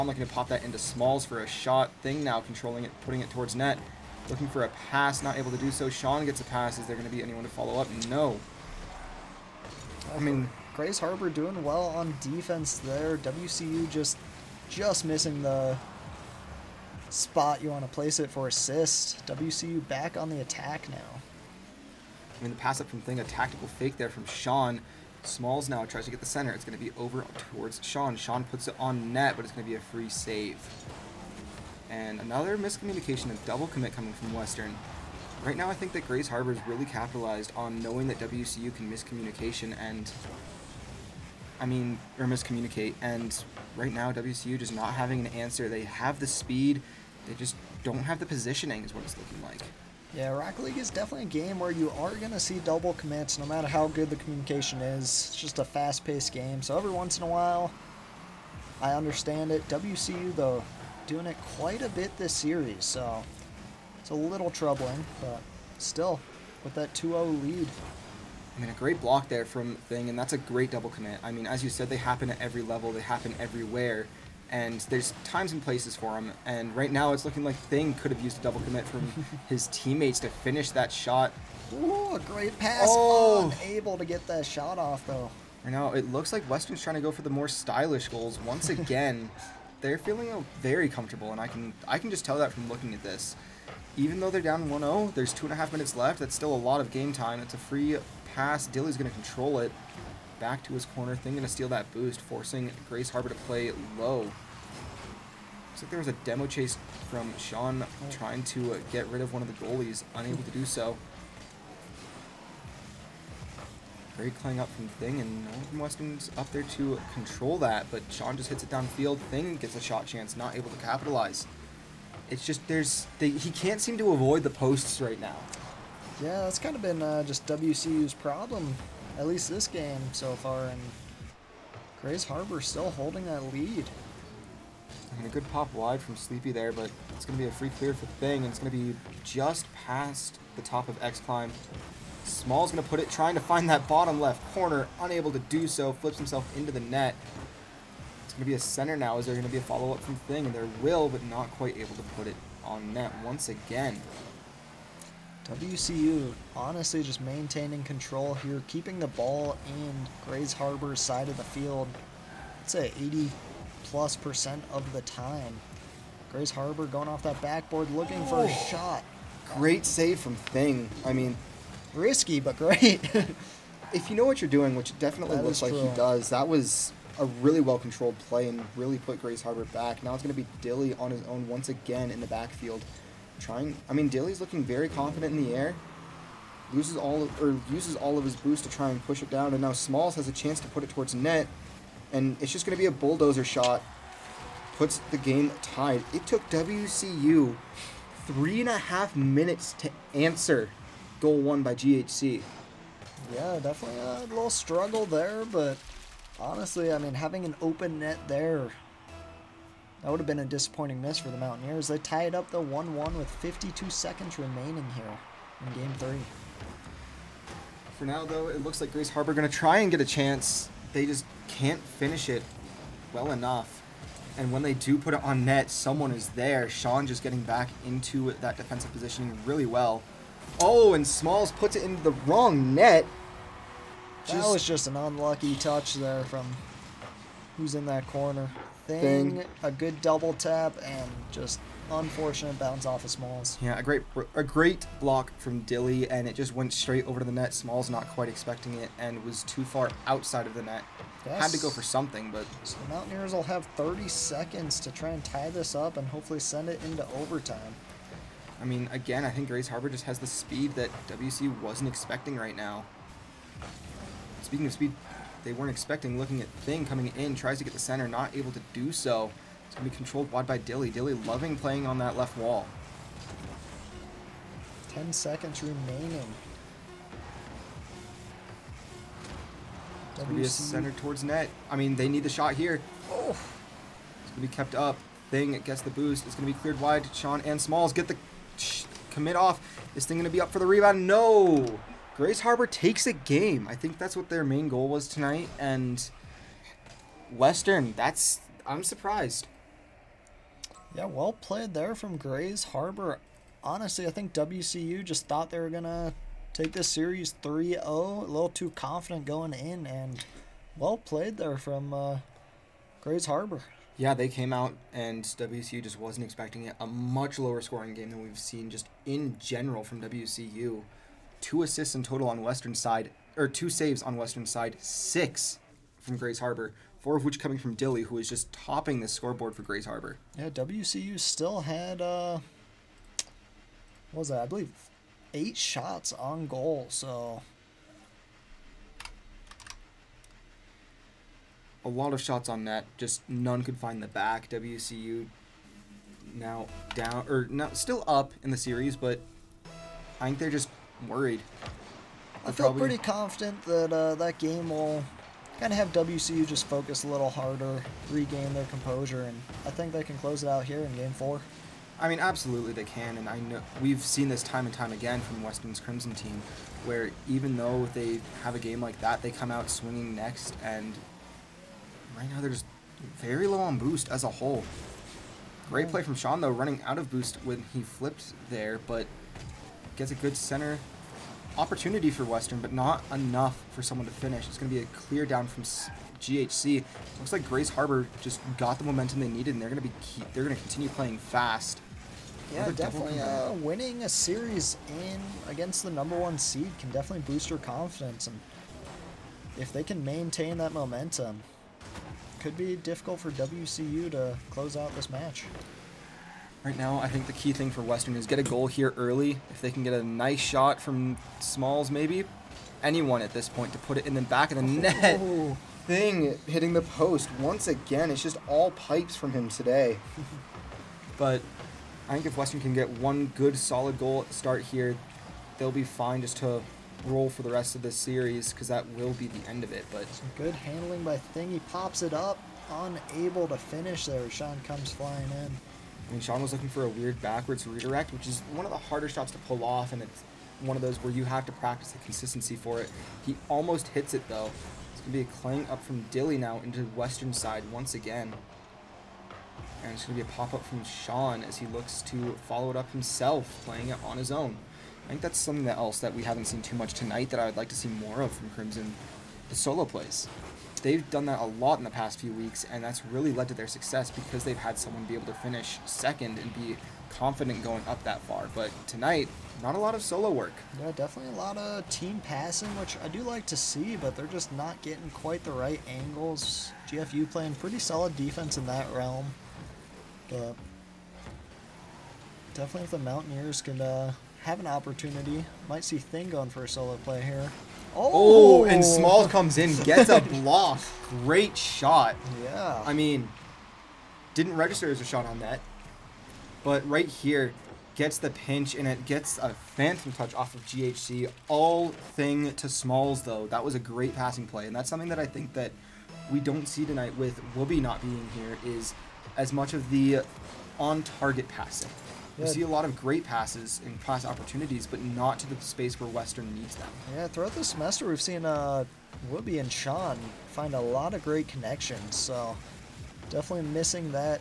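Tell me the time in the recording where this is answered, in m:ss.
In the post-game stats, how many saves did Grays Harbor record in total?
5:24.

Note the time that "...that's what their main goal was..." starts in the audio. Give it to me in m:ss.
4:53.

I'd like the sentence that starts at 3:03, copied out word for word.
Trying, I mean, Dilly's looking very confident in the air.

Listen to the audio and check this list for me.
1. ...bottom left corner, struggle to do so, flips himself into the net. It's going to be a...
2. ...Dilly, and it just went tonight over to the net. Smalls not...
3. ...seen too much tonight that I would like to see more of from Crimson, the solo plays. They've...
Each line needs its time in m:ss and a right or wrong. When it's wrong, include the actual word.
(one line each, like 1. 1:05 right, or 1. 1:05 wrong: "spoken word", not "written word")
1. 2:23 wrong: "unable", not "struggle"
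2. 4:05 wrong: "straight", not "tonight"
3. 7:36 right.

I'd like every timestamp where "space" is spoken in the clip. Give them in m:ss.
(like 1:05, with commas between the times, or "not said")
8:35.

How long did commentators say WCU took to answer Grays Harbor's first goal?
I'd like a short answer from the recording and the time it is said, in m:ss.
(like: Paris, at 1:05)
3.5 minutes, at 3:18.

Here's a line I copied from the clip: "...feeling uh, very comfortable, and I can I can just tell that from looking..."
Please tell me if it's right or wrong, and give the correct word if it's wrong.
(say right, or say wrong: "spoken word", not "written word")
right.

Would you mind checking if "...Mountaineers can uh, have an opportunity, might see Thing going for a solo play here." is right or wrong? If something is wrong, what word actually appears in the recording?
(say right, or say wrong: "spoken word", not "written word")
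right.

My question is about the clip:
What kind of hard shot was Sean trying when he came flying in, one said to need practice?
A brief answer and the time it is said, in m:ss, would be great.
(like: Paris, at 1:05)
Backwards redirect, at 7:17.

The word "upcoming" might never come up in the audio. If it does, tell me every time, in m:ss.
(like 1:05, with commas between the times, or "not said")
not said.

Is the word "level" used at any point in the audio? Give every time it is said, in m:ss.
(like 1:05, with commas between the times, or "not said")
1:12.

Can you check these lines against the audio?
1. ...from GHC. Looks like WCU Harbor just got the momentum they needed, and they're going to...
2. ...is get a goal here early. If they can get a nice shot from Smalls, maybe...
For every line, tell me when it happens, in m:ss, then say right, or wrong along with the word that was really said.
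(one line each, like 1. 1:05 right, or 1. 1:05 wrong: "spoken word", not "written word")
1. 6:25 wrong: "Grays", not "WCU"
2. 6:48 right.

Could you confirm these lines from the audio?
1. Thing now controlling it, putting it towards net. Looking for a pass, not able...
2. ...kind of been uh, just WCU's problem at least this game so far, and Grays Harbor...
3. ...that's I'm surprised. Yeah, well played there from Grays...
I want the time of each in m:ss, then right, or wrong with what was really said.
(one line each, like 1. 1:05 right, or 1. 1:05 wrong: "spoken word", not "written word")
1. 0:02 right
2. 2:06 right
3. 4:57 right.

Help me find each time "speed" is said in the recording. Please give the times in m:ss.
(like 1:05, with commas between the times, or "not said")
0:46, 4:20, 4:24.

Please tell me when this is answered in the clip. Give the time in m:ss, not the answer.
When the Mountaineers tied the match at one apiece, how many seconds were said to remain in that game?
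3:33.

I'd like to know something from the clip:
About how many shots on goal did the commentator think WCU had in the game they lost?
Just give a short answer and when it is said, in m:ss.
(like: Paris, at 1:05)
8, at 5:35.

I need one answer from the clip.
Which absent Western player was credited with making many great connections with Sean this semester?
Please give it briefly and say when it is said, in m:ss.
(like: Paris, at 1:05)
Whoopi, at 8:39.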